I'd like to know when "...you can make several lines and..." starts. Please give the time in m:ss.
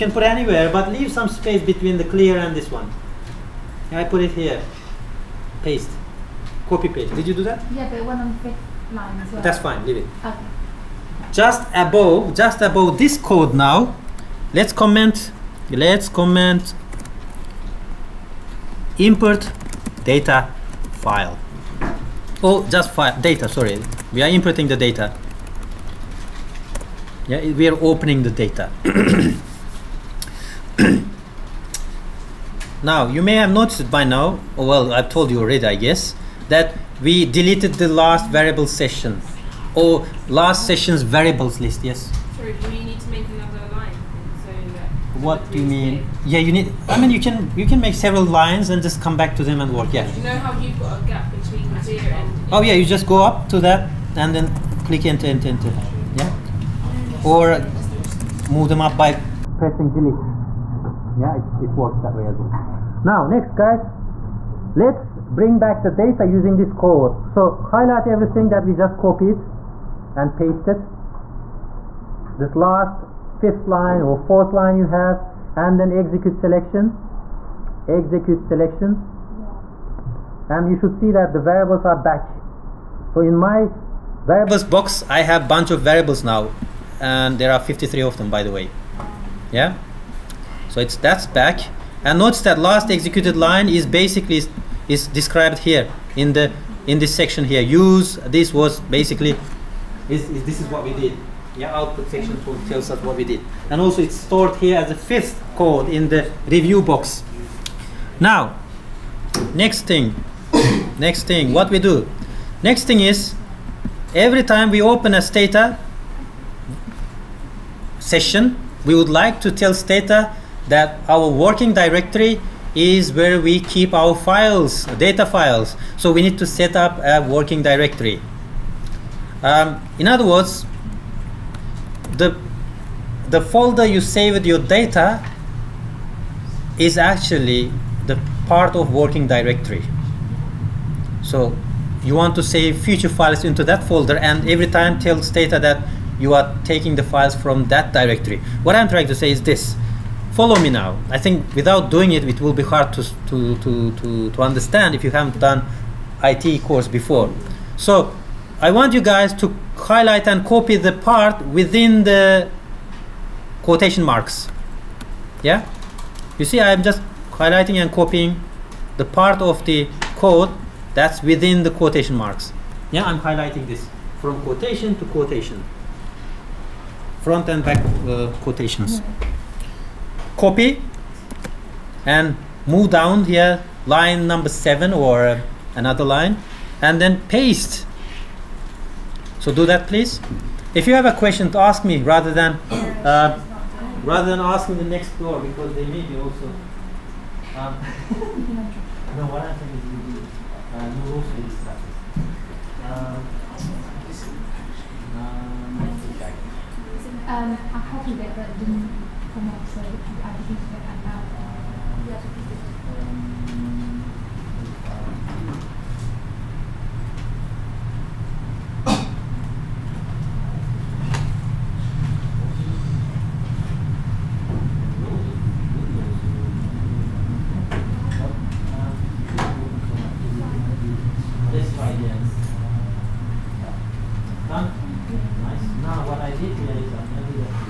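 0:47.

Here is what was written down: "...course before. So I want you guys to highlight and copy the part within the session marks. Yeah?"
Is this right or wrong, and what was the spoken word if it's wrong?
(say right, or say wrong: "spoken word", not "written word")
wrong: "quotation", not "session".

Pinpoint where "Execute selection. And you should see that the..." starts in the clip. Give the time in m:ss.
1:17.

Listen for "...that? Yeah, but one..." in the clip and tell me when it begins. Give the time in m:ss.
0:07.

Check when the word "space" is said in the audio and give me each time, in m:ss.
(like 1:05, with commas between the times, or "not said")
0:01.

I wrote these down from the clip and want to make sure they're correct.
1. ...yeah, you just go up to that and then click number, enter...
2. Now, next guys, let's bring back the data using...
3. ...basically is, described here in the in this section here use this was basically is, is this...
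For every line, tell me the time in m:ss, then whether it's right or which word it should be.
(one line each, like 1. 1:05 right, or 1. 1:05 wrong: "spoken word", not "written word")
1. 0:52 wrong: "enter", not "number"
2. 1:03 right
3. 1:33 right.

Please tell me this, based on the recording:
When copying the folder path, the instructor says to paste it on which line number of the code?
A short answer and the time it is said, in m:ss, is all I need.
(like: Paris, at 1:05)
7, at 3:04.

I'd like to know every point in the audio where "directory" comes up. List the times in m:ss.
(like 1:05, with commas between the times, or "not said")
2:01, 2:07, 2:19, 2:27.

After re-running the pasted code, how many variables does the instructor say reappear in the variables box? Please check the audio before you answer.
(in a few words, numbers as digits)
53.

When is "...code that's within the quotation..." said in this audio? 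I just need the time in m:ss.
2:50.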